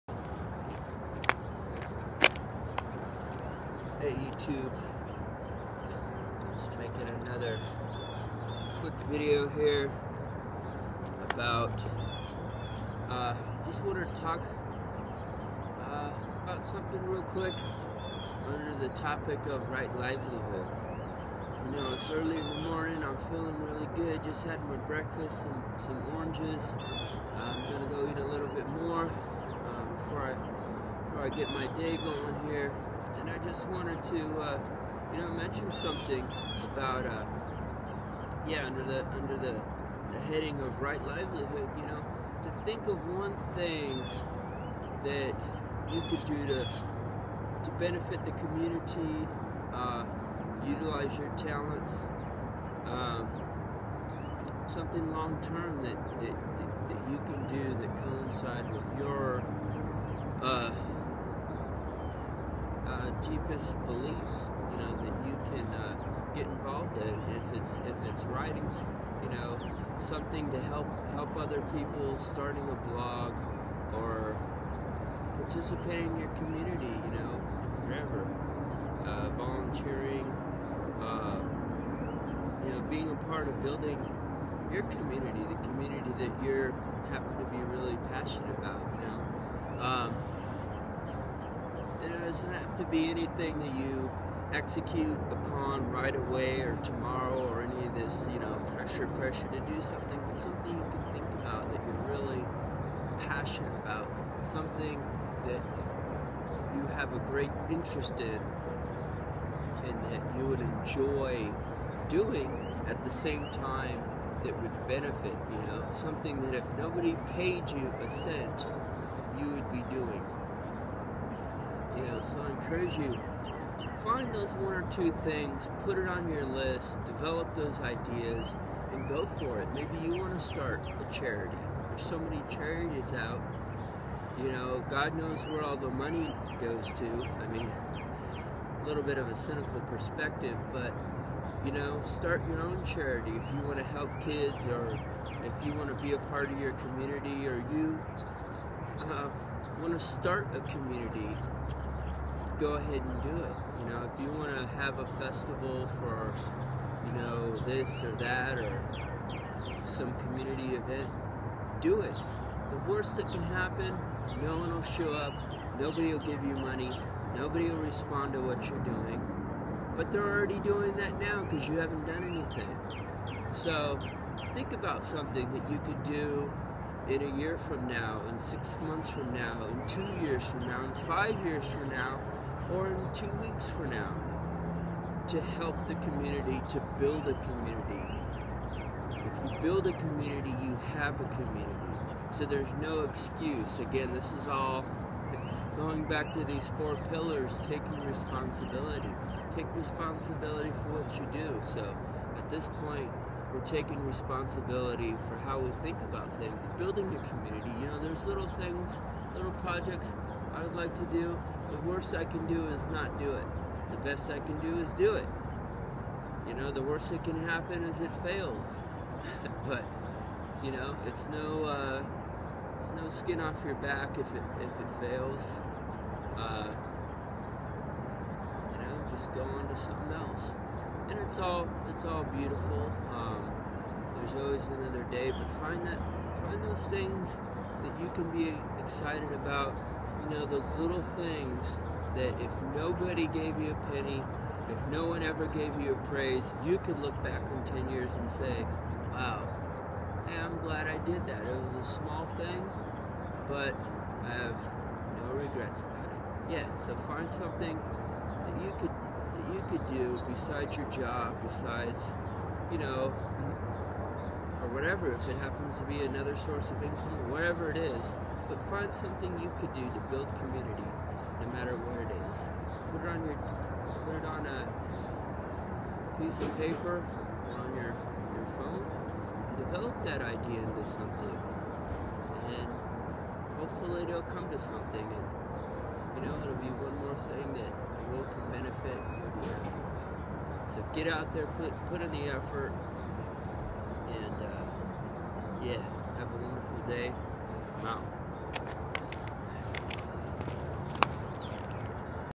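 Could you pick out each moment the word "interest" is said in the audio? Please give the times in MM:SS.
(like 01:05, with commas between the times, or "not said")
01:47.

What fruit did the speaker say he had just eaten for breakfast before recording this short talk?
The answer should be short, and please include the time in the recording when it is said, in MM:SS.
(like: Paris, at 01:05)
Oranges, at 00:26.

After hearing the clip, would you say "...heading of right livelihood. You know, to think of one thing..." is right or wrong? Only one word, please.
right.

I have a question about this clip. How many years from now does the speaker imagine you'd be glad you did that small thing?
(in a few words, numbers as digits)
10.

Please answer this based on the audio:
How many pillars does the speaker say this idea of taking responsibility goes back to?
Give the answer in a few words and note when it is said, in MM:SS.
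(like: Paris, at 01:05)
4, at 03:16.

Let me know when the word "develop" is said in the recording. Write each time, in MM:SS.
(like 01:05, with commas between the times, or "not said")
02:07, 04:39.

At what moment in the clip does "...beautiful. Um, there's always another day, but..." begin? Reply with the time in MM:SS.
03:52.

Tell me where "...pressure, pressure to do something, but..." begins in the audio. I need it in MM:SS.
01:38.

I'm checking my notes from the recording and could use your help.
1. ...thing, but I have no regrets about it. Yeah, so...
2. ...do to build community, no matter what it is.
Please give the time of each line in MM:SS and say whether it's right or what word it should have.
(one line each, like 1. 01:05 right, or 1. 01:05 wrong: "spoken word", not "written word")
1. 04:12 right
2. 04:29 right.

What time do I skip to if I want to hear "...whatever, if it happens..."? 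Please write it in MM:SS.
04:24.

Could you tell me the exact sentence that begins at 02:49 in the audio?
But they're already doing that now because you haven't done anything.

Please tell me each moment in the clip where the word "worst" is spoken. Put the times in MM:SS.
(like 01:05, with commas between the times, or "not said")
02:42, 03:31, 03:36.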